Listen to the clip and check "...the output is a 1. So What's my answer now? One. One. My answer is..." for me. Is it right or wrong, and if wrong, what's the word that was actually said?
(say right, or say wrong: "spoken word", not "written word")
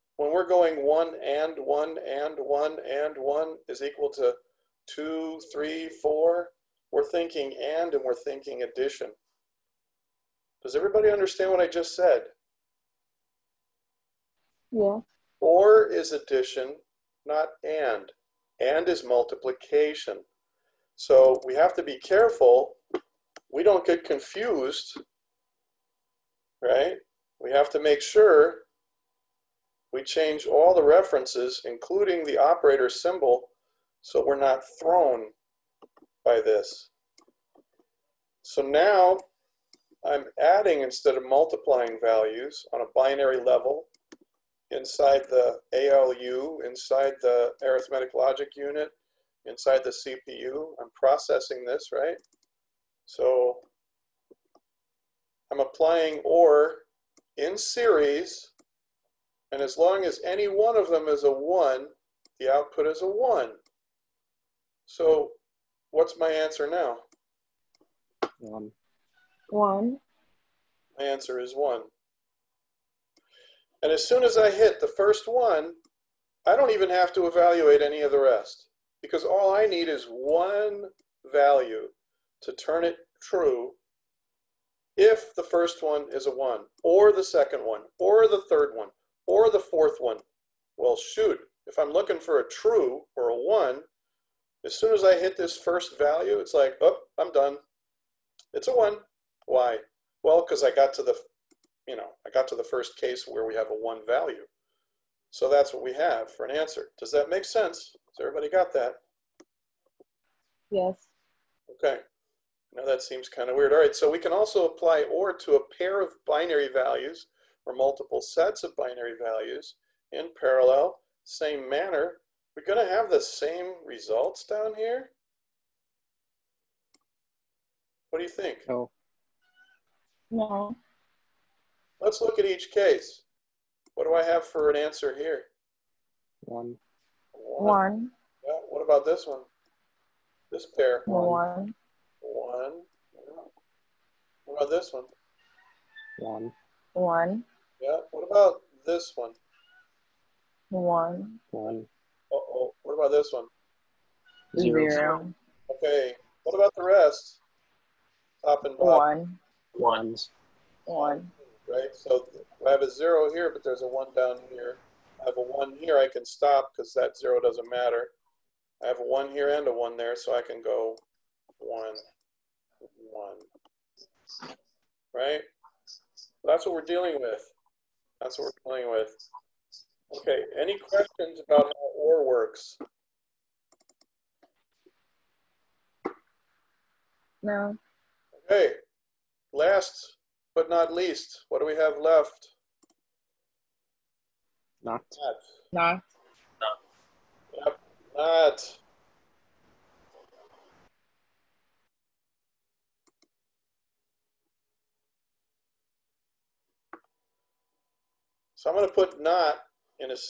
right.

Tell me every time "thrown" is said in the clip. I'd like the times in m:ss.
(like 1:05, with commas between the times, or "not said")
0:34.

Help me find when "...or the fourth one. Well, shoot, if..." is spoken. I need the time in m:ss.
1:29.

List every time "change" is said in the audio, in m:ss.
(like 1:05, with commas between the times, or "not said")
0:30.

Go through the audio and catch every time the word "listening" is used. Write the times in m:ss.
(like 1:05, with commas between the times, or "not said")
not said.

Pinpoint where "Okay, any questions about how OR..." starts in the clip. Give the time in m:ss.
3:00.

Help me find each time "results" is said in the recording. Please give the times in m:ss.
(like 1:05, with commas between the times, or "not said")
2:03.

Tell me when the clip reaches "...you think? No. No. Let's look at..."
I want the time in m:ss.
2:08.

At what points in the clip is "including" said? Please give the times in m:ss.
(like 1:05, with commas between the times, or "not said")
0:31.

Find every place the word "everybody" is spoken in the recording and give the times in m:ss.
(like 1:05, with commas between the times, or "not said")
0:10, 1:48.